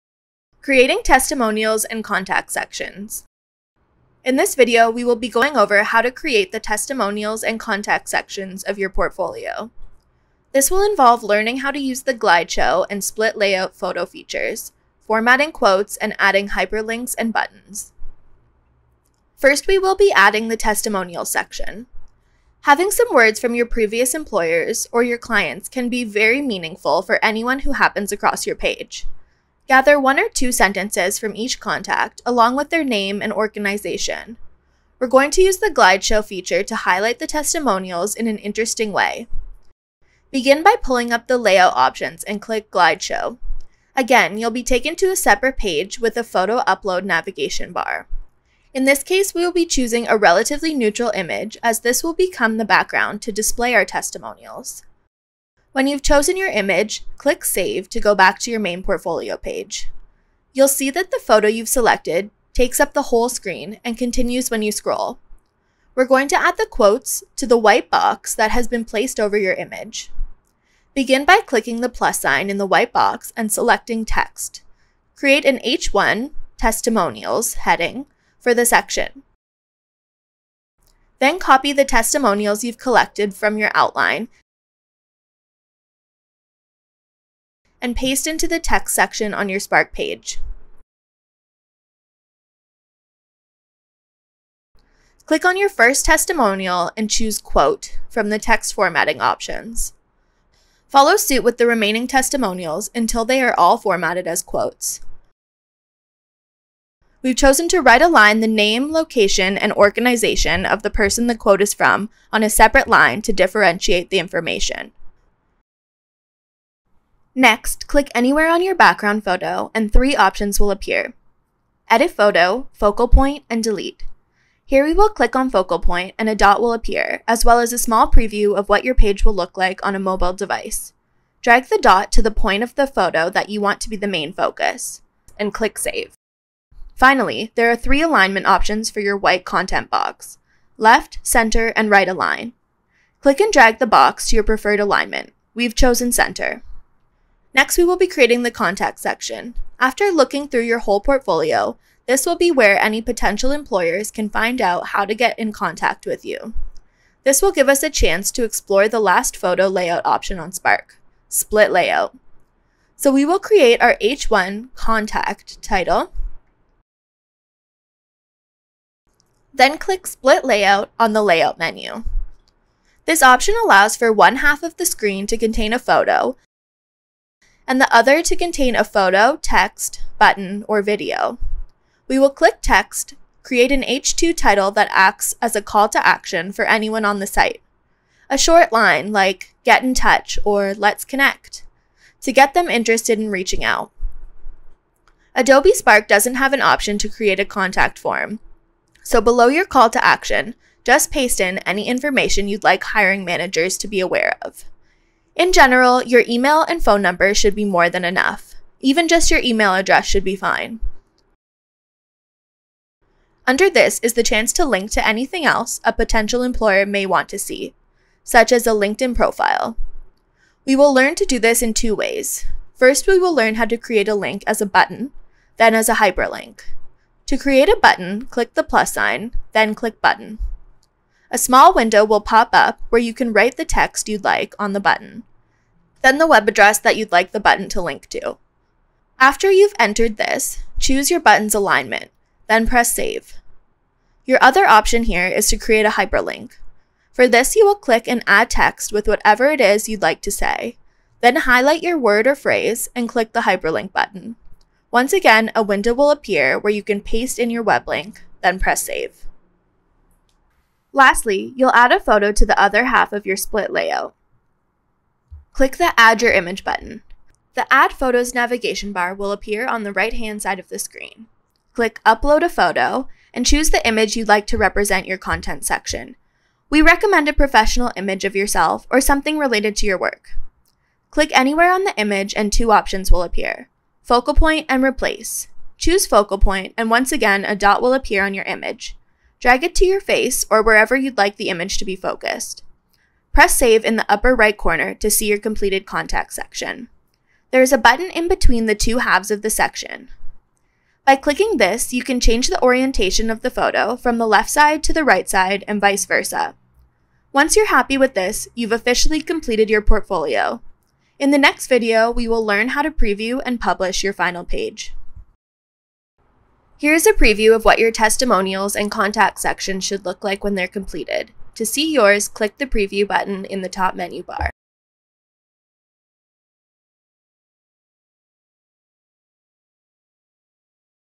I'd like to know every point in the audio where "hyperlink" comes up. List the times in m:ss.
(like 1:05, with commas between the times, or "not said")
0:16, 3:45, 4:05, 4:13.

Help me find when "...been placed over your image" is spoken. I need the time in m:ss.
1:08.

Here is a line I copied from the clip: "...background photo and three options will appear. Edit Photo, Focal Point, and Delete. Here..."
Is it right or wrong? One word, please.
right.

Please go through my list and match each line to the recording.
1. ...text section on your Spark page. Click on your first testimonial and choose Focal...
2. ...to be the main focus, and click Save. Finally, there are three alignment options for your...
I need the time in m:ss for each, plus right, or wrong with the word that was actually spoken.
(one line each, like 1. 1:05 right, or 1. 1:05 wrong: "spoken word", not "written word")
1. 1:28 wrong: "Quote", not "Focal"
2. 2:13 right.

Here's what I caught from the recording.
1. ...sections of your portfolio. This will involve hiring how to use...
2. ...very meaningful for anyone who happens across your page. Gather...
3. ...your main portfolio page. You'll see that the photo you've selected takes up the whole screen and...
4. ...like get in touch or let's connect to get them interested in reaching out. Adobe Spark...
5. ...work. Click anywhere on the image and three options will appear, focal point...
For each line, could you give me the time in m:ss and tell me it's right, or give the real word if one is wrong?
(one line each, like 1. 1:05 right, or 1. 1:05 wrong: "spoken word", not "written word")
1. 0:08 wrong: "learning", not "hiring"
2. 0:26 right
3. 0:58 right
4. 3:09 right
5. 4:39 wrong: "two", not "three".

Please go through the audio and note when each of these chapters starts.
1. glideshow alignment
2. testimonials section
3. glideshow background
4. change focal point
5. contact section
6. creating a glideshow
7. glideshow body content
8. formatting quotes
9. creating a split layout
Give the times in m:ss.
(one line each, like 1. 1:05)
1. 2:15
2. 0:19
3. 0:49
4. 2:00
5. 2:27
6. 0:34
7. 1:04
8. 1:35
9. 2:41.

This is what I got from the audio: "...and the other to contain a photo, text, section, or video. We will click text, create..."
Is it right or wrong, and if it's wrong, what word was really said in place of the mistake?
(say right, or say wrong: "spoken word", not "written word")
wrong: "button", not "section".